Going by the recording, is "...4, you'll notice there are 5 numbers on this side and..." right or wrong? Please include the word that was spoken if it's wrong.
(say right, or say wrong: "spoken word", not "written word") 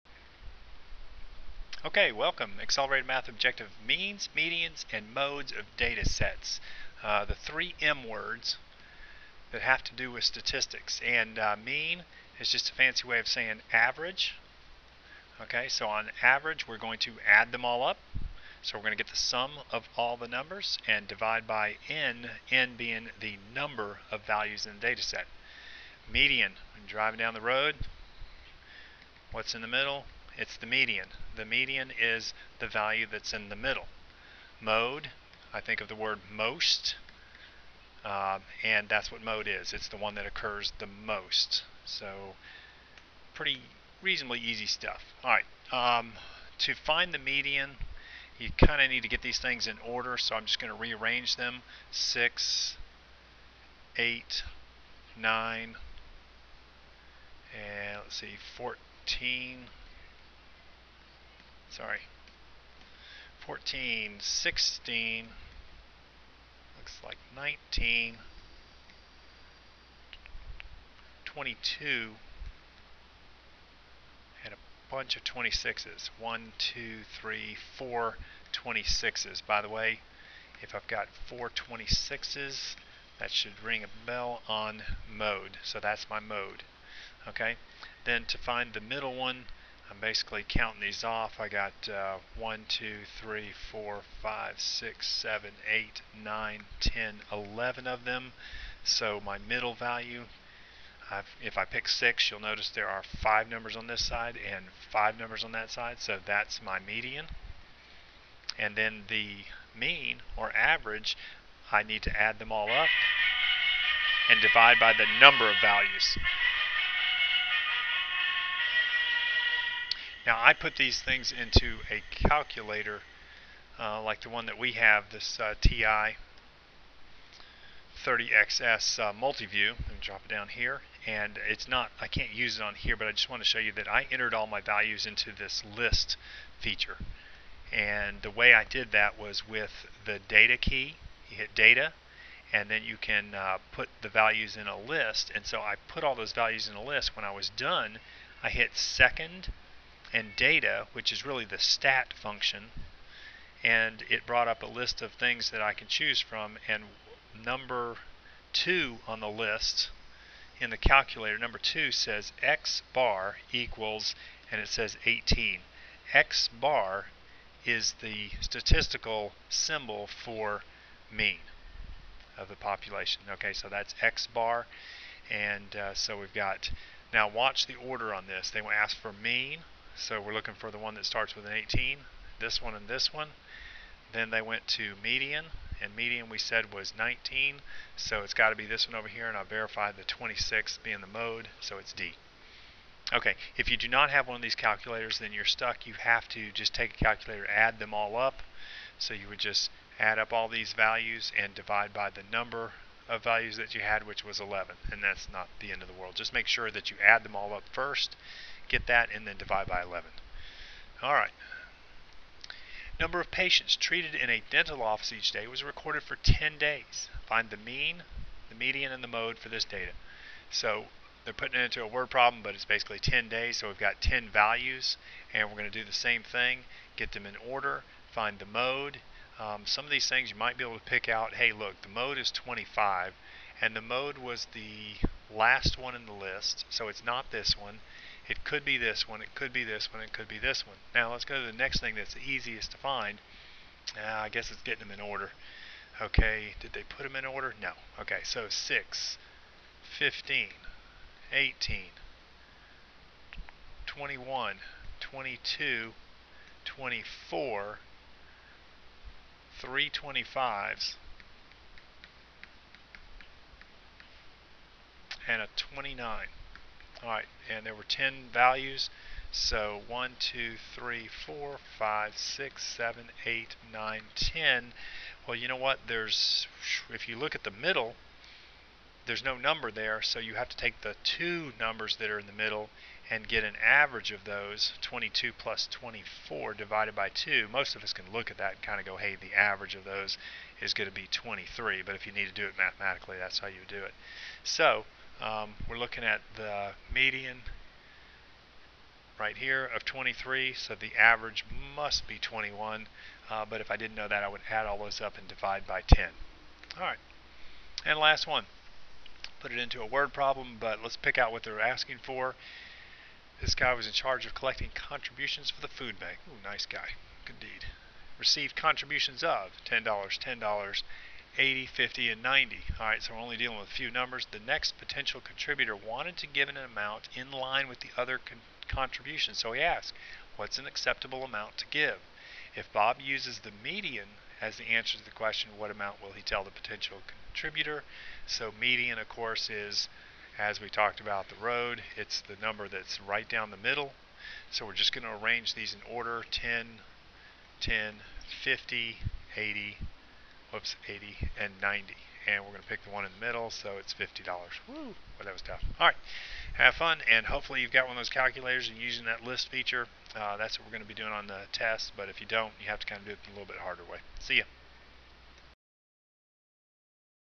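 wrong: "6", not "4".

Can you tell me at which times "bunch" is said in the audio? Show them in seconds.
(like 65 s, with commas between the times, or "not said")
74 s.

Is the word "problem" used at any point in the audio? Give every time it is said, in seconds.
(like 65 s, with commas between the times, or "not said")
222 s, 310 s.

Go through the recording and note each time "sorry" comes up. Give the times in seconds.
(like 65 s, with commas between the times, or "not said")
61 s.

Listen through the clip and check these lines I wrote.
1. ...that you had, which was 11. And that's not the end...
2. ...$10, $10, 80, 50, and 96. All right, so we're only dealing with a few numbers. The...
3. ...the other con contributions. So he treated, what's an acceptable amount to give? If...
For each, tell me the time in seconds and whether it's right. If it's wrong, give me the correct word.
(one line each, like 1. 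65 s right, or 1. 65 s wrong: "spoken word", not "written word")
1. 203 s right
2. 319 s wrong: "90", not "96"
3. 327 s wrong: "asked", not "treated".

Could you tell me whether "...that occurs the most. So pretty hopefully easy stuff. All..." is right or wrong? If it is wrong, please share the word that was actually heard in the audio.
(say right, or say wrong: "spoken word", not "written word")
wrong: "reasonably", not "hopefully".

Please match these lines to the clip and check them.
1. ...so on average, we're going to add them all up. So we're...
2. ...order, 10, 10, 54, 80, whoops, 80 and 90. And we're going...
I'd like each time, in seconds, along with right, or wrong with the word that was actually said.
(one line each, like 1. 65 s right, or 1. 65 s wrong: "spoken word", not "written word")
1. 15 s right
2. 345 s wrong: "50", not "54".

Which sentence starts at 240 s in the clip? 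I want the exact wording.
Now let's go to the next thing that's the easiest to find.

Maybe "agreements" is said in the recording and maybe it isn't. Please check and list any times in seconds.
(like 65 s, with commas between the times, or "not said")
not said.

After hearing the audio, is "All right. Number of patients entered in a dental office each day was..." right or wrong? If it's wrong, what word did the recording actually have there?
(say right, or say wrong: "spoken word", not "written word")
wrong: "treated", not "entered".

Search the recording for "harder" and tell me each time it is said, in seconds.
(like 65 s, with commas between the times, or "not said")
363 s.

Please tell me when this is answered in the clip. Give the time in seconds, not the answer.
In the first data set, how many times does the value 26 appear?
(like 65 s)
77 s.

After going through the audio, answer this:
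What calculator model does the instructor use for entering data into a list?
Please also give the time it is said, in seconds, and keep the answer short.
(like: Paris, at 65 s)
TI 30XS Multiview, at 125 s.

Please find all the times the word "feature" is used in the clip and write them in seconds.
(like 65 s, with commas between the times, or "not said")
136 s, 359 s.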